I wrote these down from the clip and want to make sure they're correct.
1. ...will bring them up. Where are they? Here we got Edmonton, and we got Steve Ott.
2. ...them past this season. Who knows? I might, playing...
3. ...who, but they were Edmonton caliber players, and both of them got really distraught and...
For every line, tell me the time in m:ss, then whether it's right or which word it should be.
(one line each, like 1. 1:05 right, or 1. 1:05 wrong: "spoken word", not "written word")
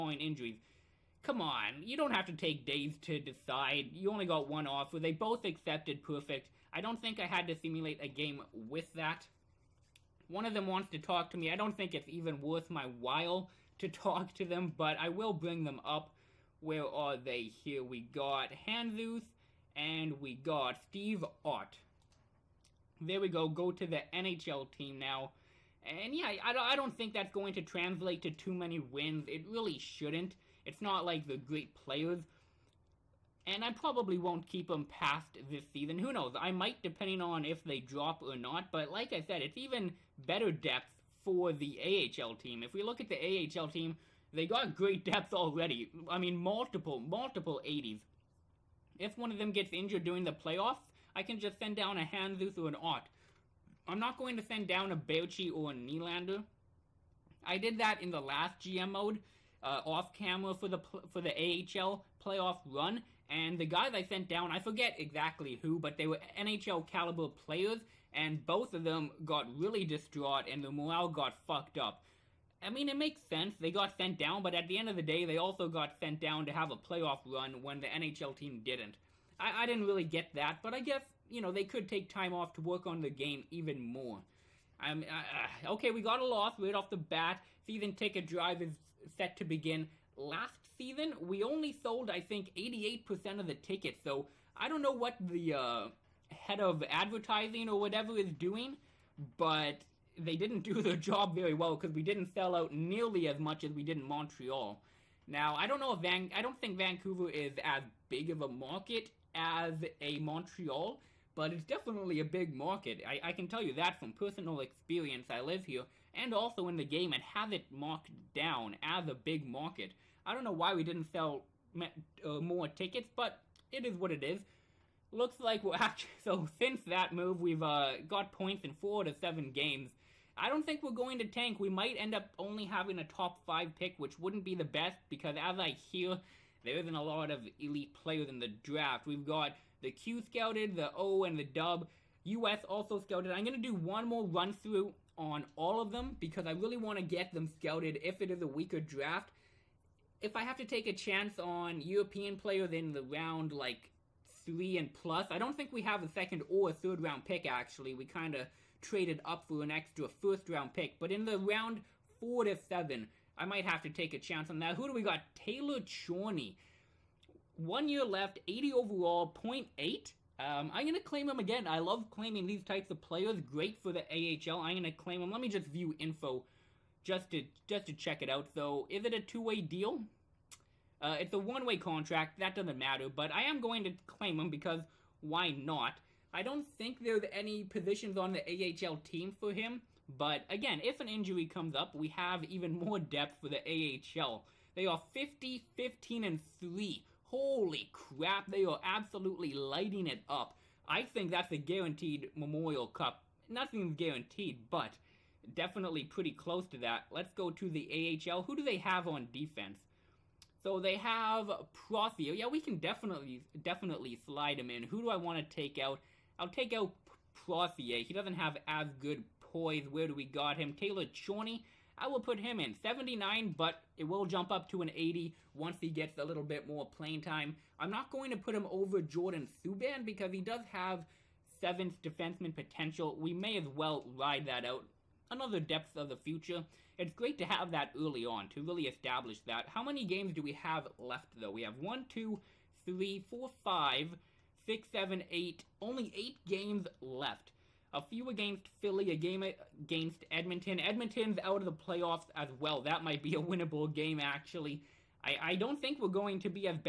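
1. 0:15 wrong: "Hanzuth", not "Edmonton"
2. 0:34 wrong: "depending", not "playing"
3. 1:05 wrong: "NHL", not "Edmonton".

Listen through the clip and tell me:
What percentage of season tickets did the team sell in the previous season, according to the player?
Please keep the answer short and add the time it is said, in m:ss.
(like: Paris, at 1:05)
88%, at 1:32.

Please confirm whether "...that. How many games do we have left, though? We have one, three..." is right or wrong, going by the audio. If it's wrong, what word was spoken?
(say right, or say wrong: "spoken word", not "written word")
wrong: "two", not "three".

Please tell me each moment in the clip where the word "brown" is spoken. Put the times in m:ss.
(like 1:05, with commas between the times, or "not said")
not said.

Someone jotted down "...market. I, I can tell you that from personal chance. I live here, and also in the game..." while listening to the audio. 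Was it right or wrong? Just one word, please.
wrong.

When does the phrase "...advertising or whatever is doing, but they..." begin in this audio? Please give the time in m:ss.
1:36.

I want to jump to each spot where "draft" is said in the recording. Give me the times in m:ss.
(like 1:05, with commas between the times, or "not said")
2:18, 2:28.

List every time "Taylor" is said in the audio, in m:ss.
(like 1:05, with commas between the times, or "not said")
2:45, 3:40.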